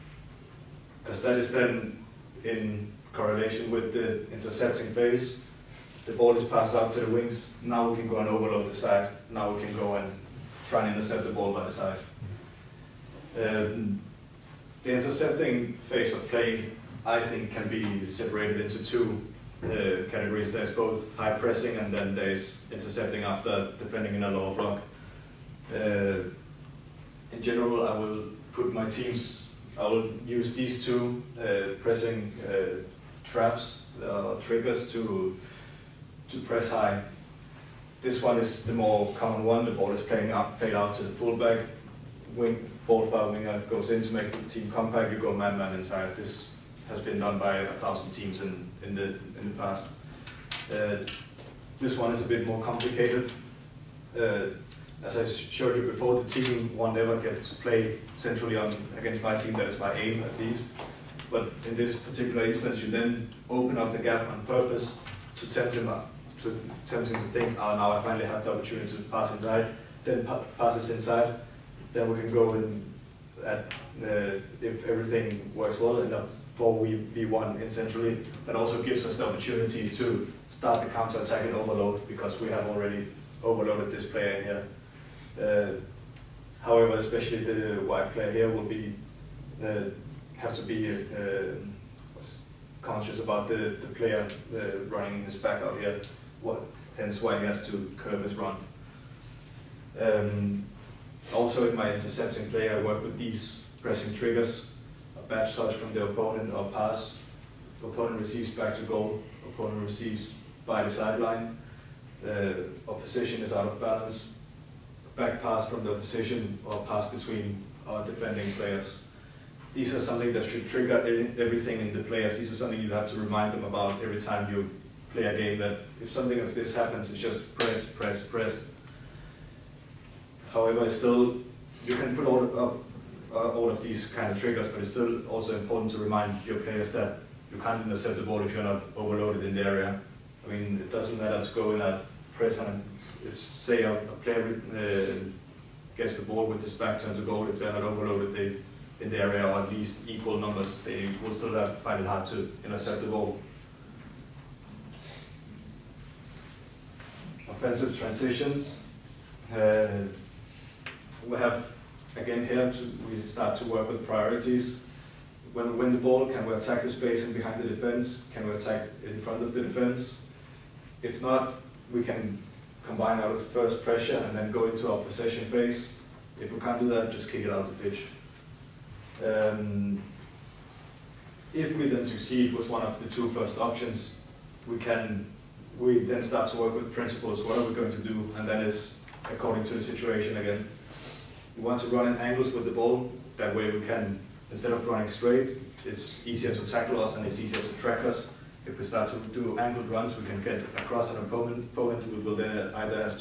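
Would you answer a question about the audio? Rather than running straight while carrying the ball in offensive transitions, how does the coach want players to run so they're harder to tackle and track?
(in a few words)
In angles.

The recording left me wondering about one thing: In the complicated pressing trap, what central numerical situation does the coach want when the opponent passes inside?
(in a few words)
4v1.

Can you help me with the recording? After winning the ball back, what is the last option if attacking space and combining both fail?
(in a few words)
Kick it out the pitch.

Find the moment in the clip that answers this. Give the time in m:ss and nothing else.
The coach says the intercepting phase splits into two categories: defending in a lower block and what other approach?
0:21.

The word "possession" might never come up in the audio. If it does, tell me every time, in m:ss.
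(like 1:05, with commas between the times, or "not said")
2:54.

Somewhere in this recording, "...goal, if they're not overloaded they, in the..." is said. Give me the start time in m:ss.
2:27.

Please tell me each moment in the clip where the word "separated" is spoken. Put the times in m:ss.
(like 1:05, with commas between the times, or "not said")
0:18.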